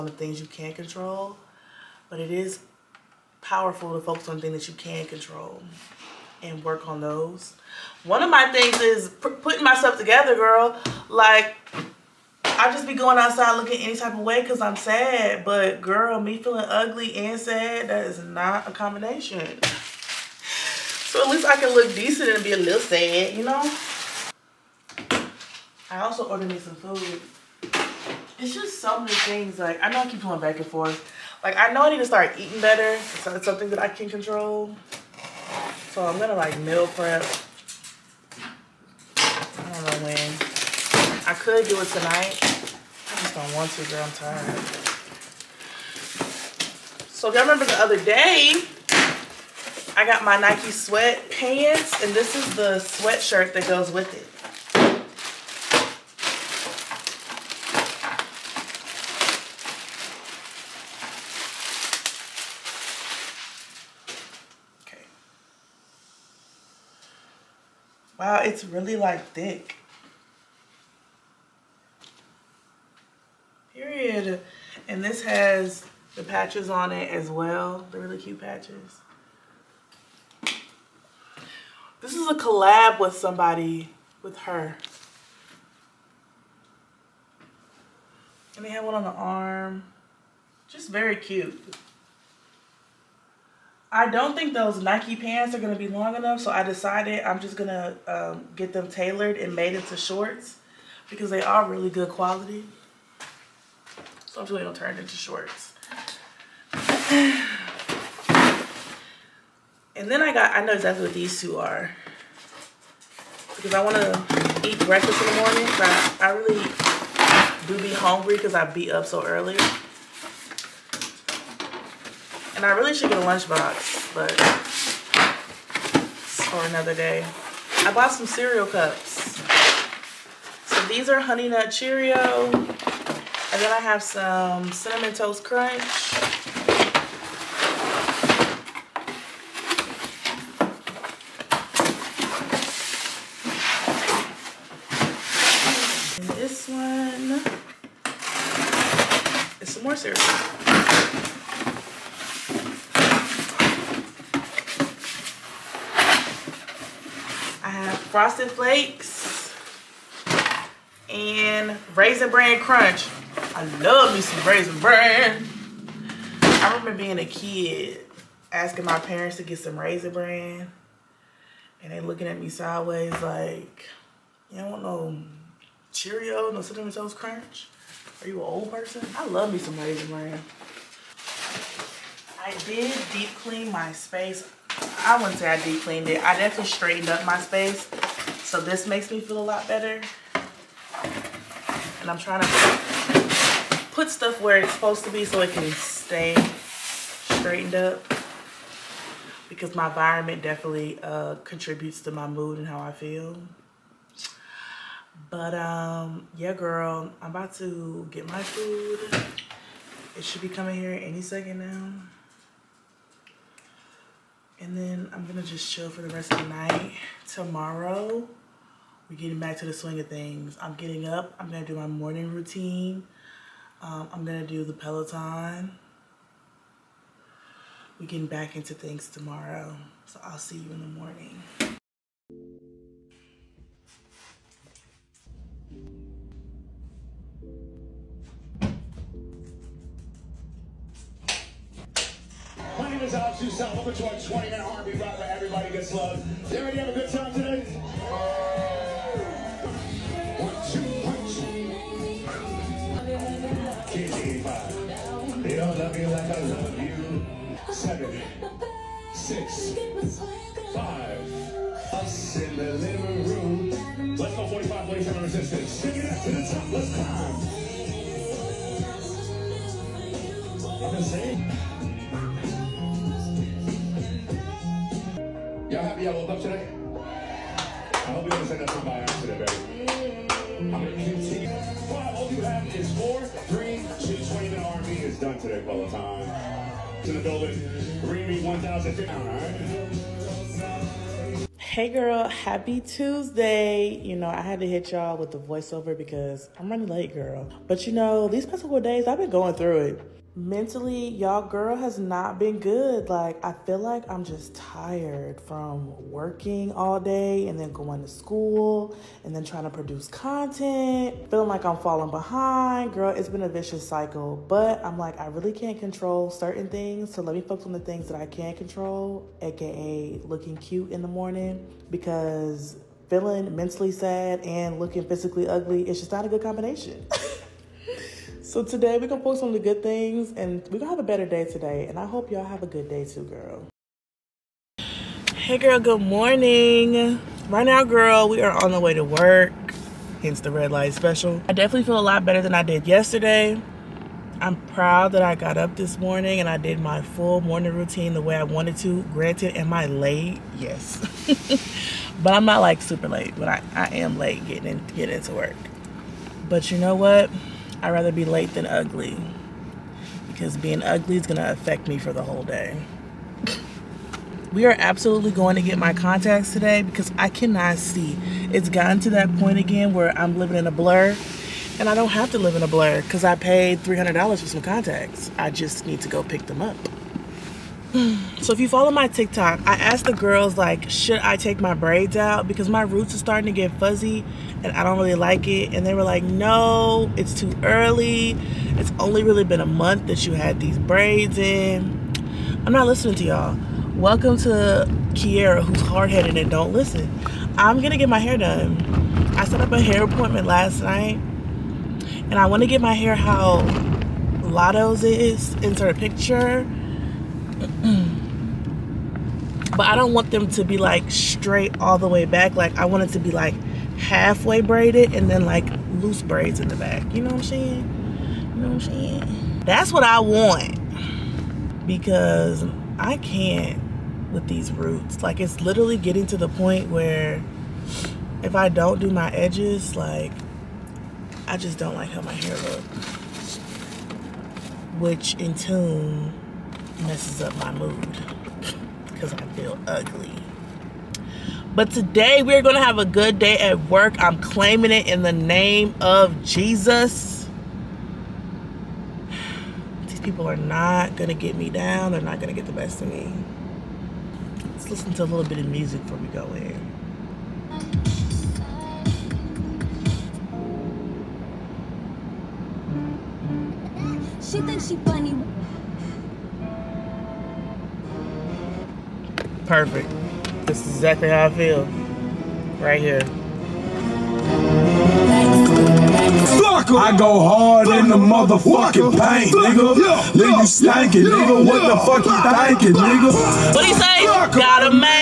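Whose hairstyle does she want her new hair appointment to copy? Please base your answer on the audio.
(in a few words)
Latto.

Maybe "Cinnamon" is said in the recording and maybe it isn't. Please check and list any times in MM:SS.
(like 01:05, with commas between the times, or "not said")
02:14, 02:56.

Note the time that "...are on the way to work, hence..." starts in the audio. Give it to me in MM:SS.
05:38.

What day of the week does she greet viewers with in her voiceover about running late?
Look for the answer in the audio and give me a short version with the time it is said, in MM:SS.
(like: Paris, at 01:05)
Tuesday, at 04:52.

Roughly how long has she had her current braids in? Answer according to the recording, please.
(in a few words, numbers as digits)
A month.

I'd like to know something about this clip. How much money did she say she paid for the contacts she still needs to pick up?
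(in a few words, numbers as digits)
$300.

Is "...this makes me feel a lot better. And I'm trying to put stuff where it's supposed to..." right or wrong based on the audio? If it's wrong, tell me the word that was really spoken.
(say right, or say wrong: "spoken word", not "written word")
right.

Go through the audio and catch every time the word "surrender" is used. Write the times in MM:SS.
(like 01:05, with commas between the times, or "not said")
not said.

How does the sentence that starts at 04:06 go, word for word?
Did everybody have a good time today?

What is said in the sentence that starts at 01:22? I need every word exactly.
is a collab with somebody, with her.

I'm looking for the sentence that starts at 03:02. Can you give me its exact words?
I did deep clean my space.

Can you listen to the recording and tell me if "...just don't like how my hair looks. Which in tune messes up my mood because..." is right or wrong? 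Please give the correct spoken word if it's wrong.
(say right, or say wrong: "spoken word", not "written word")
right.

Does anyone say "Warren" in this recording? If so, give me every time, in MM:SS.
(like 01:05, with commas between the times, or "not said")
not said.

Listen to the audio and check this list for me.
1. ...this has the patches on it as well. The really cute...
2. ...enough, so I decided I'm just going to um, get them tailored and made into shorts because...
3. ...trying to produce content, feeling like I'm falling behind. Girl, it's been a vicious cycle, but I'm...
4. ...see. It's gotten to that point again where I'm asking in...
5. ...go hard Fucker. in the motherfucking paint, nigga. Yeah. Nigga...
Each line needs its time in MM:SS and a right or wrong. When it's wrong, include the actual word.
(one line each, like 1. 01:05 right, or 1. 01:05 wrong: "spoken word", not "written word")
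1. 01:15 right
2. 01:36 right
3. 05:09 right
4. 06:07 wrong: "living", not "asking"
5. 07:57 right.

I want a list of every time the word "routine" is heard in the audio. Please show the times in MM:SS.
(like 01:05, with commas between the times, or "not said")
03:42, 05:47.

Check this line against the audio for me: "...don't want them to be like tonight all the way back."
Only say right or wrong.
wrong.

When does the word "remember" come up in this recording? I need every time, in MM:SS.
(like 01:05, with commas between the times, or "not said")
00:47, 02:46.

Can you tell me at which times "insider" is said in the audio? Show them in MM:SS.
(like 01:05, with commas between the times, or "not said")
not said.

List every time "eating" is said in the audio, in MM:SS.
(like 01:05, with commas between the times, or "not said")
00:32.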